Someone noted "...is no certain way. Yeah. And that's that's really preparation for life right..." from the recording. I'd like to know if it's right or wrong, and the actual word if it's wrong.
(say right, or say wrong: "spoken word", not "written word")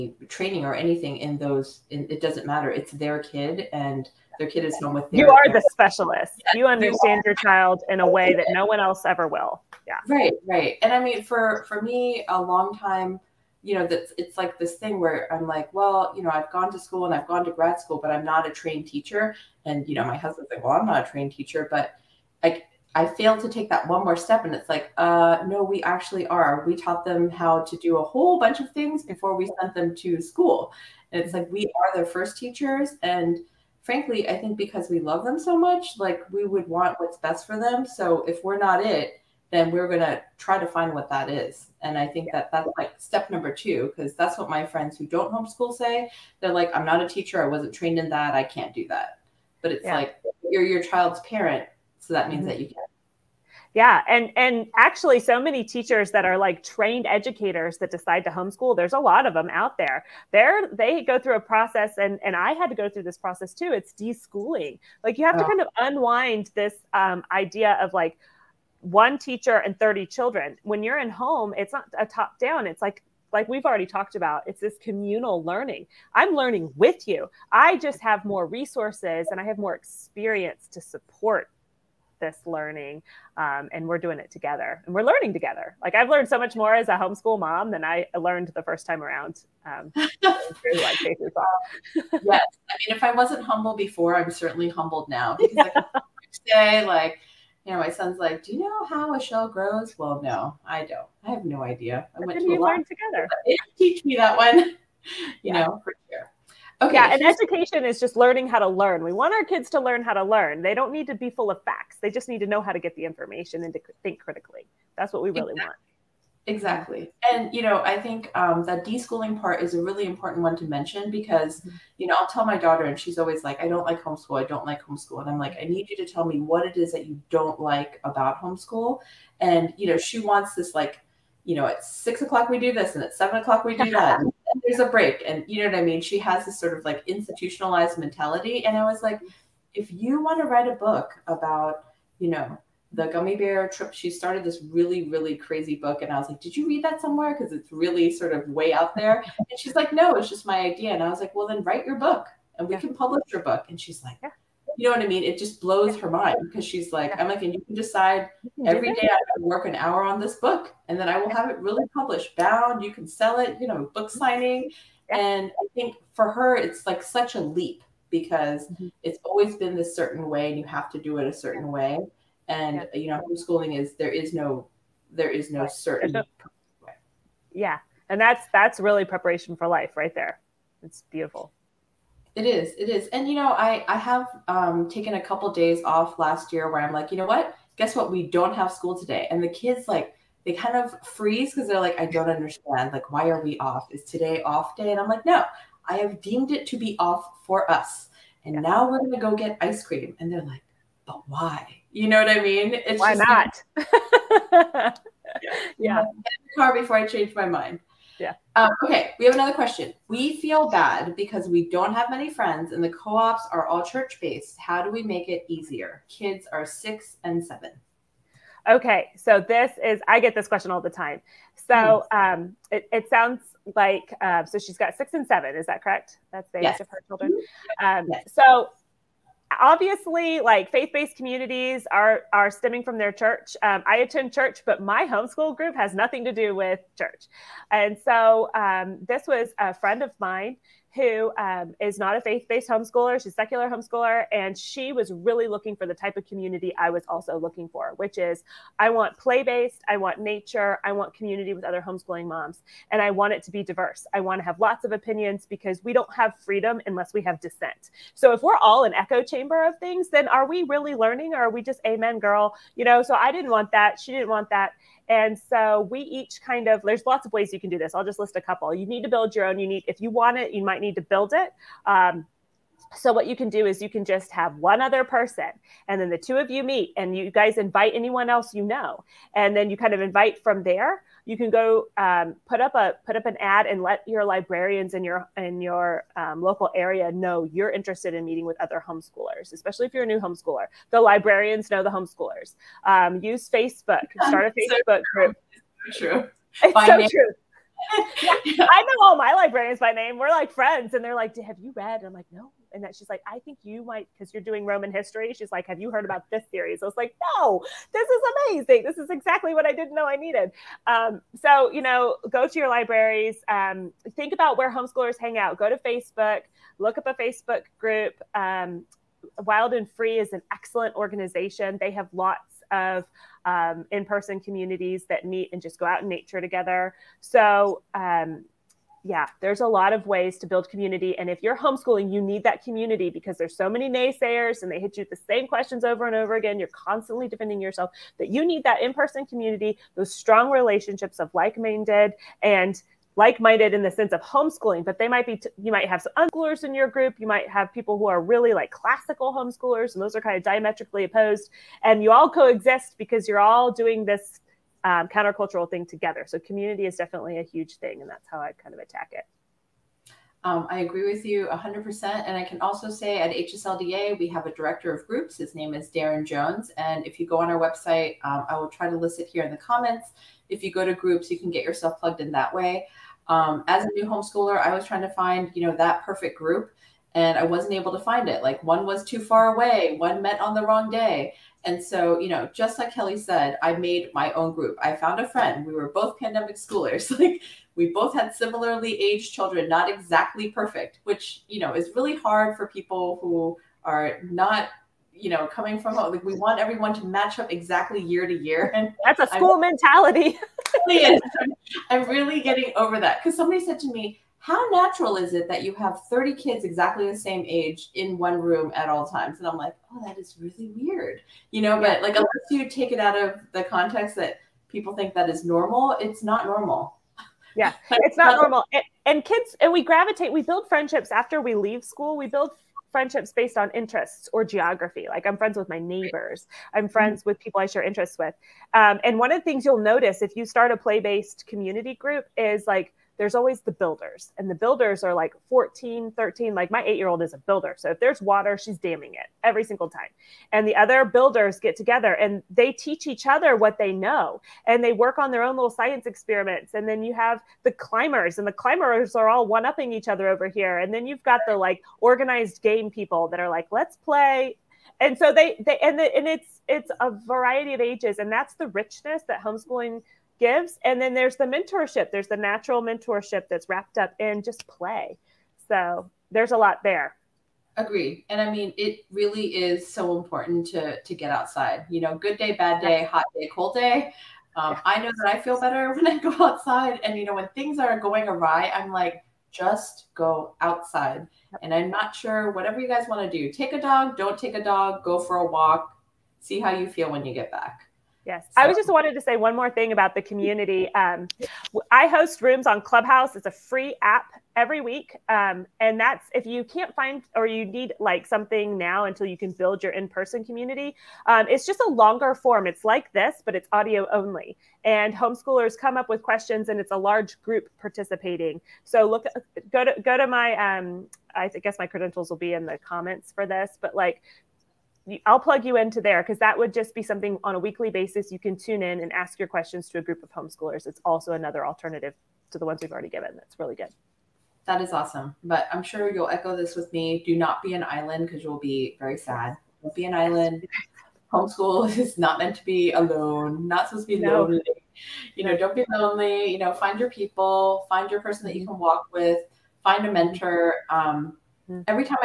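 right.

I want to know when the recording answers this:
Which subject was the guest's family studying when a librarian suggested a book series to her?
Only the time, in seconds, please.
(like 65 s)
304 s.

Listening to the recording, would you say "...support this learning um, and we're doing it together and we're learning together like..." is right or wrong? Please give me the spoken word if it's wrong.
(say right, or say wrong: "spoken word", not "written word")
right.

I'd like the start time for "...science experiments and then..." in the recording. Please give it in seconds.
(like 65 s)
445 s.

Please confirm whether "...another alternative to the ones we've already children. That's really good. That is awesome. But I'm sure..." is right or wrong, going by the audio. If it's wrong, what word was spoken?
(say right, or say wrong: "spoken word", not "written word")
wrong: "given", not "children".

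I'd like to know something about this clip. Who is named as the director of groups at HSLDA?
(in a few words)
Darren Jones.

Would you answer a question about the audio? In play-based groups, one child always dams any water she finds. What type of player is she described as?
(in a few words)
A builder.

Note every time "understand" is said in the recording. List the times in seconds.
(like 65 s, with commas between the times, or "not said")
6 s, 192 s.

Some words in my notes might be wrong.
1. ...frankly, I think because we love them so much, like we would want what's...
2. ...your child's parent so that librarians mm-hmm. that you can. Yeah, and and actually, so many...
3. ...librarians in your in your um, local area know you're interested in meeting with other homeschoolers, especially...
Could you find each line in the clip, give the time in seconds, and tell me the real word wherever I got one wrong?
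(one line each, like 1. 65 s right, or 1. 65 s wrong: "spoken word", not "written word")
1. 33 s right
2. 50 s wrong: "means", not "librarians"
3. 284 s right.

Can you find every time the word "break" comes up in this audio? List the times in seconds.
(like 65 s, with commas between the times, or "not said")
134 s.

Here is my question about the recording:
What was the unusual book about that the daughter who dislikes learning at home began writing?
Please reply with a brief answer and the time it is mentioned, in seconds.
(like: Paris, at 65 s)
The gummy bear trip, at 142 s.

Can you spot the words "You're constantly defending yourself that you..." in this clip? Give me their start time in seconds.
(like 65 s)
336 s.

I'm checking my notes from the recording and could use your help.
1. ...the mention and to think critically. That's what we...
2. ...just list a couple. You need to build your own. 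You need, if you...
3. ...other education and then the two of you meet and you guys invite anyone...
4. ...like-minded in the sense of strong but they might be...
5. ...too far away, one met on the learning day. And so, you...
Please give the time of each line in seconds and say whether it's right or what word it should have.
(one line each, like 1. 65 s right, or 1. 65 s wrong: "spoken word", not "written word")
1. 112 s wrong: "information", not "mention"
2. 268 s right
3. 274 s wrong: "person", not "education"
4. 343 s wrong: "homeschooling", not "strong"
5. 379 s wrong: "wrong", not "learning".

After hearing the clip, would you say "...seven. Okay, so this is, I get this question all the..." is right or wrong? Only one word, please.
right.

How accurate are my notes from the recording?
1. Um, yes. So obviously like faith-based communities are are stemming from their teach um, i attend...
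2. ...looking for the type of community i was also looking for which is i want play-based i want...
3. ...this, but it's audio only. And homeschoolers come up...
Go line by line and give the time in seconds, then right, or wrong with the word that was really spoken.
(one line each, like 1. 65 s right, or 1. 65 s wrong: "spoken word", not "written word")
1. 227 s wrong: "church", not "teach"
2. 245 s right
3. 503 s right.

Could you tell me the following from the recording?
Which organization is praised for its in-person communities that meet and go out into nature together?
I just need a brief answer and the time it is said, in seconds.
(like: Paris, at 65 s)
Wild and Free, at 319 s.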